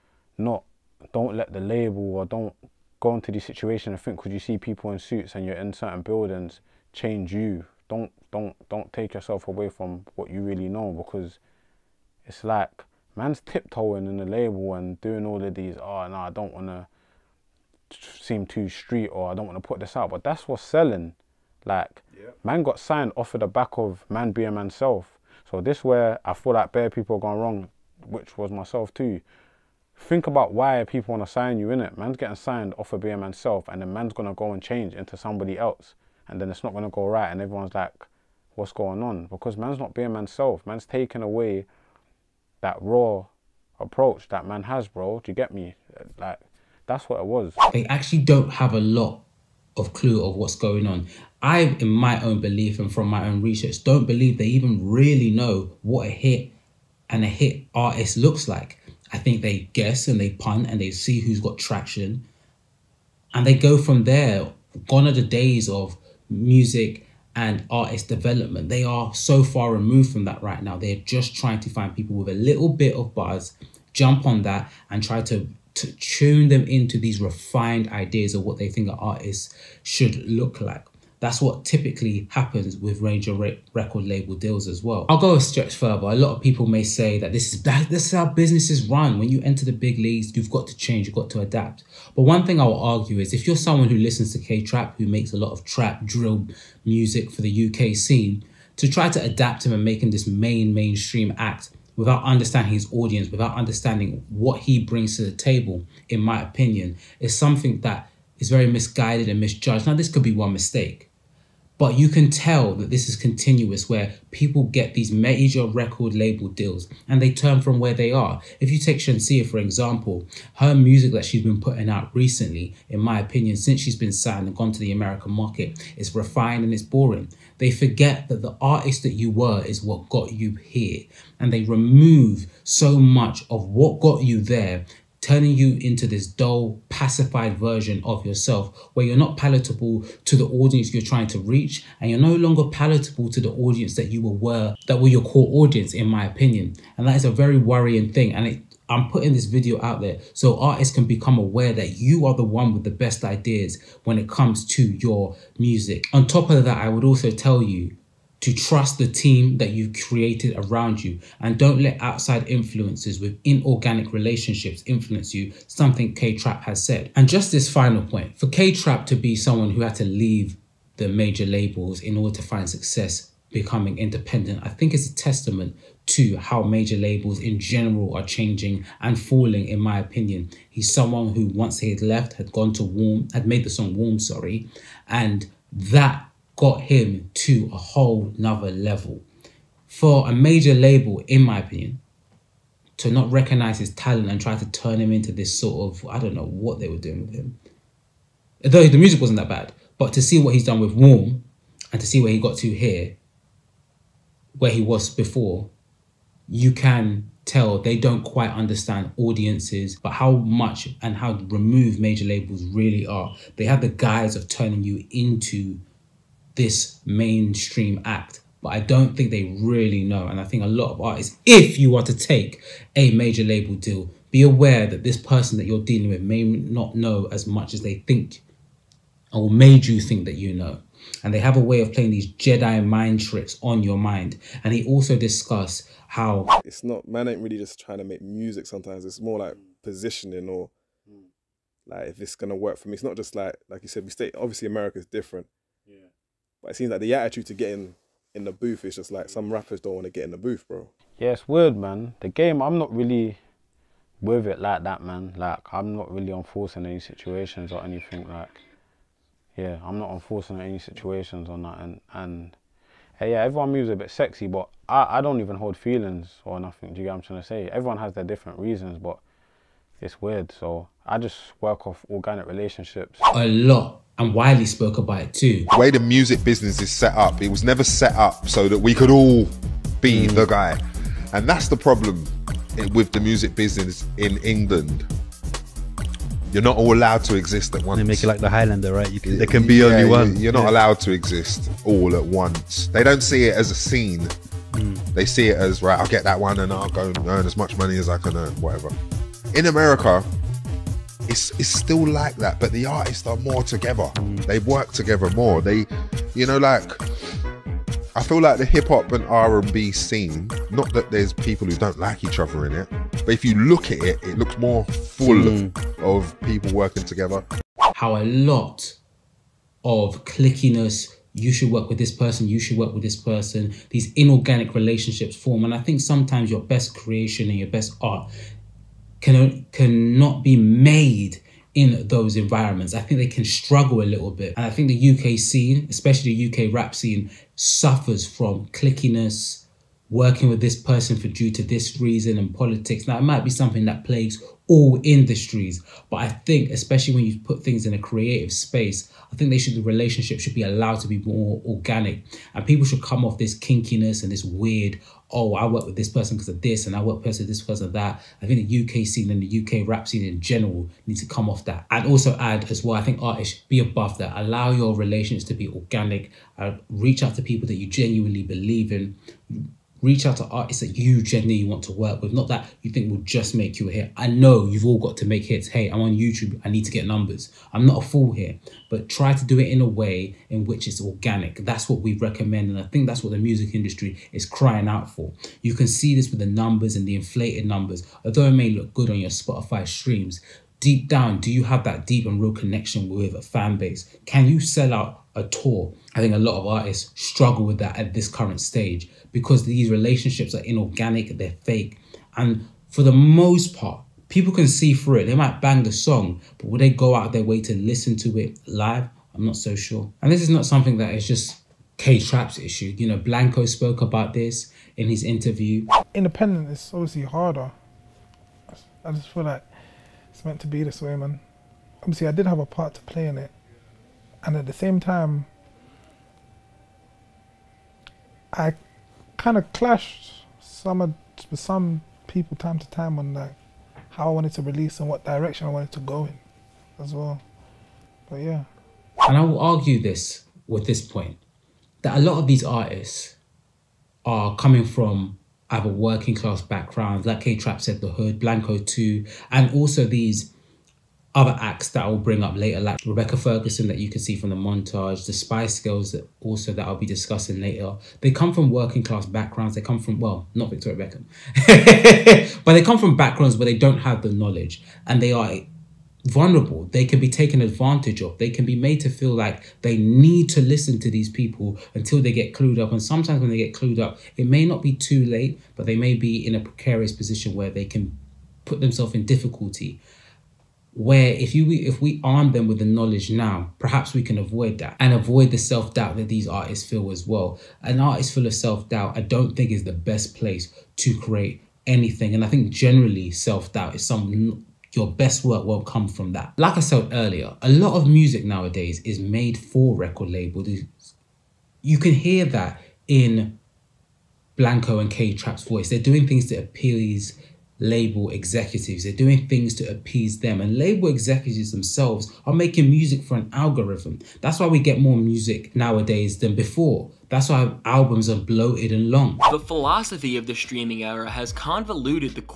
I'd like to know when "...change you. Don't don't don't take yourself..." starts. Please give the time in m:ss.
0:06.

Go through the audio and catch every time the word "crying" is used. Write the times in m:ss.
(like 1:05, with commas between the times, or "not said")
6:24.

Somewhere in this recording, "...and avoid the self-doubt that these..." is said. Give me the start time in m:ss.
8:04.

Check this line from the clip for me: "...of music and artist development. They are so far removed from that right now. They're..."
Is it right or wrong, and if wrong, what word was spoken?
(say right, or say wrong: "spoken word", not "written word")
right.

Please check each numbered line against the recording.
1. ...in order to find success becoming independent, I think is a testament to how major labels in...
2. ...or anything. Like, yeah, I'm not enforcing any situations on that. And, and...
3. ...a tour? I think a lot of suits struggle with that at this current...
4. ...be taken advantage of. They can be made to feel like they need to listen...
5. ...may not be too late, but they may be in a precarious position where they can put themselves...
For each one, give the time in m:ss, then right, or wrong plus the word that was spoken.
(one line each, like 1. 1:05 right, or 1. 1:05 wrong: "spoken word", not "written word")
1. 2:51 right
2. 4:17 right
3. 6:35 wrong: "artists", not "suits"
4. 7:47 right
5. 7:54 right.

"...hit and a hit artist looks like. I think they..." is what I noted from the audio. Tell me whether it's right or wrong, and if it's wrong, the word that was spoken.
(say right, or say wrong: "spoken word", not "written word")
right.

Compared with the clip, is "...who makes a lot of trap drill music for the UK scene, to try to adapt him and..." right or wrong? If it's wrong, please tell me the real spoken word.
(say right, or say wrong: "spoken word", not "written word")
right.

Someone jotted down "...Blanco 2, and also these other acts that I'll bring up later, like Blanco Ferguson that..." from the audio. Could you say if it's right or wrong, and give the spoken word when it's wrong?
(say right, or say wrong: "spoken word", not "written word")
wrong: "Rebecca", not "Blanco".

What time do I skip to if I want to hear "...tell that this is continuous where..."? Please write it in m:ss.
1:52.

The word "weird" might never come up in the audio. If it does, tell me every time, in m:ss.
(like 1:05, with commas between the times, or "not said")
4:11, 4:30, 5:54.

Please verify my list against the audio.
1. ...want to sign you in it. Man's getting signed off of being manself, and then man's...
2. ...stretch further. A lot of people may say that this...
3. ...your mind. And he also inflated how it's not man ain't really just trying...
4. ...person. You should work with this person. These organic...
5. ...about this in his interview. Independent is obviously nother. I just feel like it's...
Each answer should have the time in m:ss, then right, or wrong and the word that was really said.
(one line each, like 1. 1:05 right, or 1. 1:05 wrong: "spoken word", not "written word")
1. 0:31 right
2. 1:25 right
3. 3:53 wrong: "discussed", not "inflated"
4. 5:22 wrong: "inorganic", not "organic"
5. 6:54 wrong: "harder", not "nother".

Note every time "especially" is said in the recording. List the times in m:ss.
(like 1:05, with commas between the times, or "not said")
5:35, 5:46.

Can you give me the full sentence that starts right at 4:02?
It's not just like like you said, we stay obviously America's different.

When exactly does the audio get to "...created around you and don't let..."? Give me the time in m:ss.
2:40.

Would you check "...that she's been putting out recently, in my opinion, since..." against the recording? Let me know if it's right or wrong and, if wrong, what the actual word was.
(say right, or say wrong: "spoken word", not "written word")
right.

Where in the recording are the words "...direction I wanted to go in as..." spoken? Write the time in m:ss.
7:15.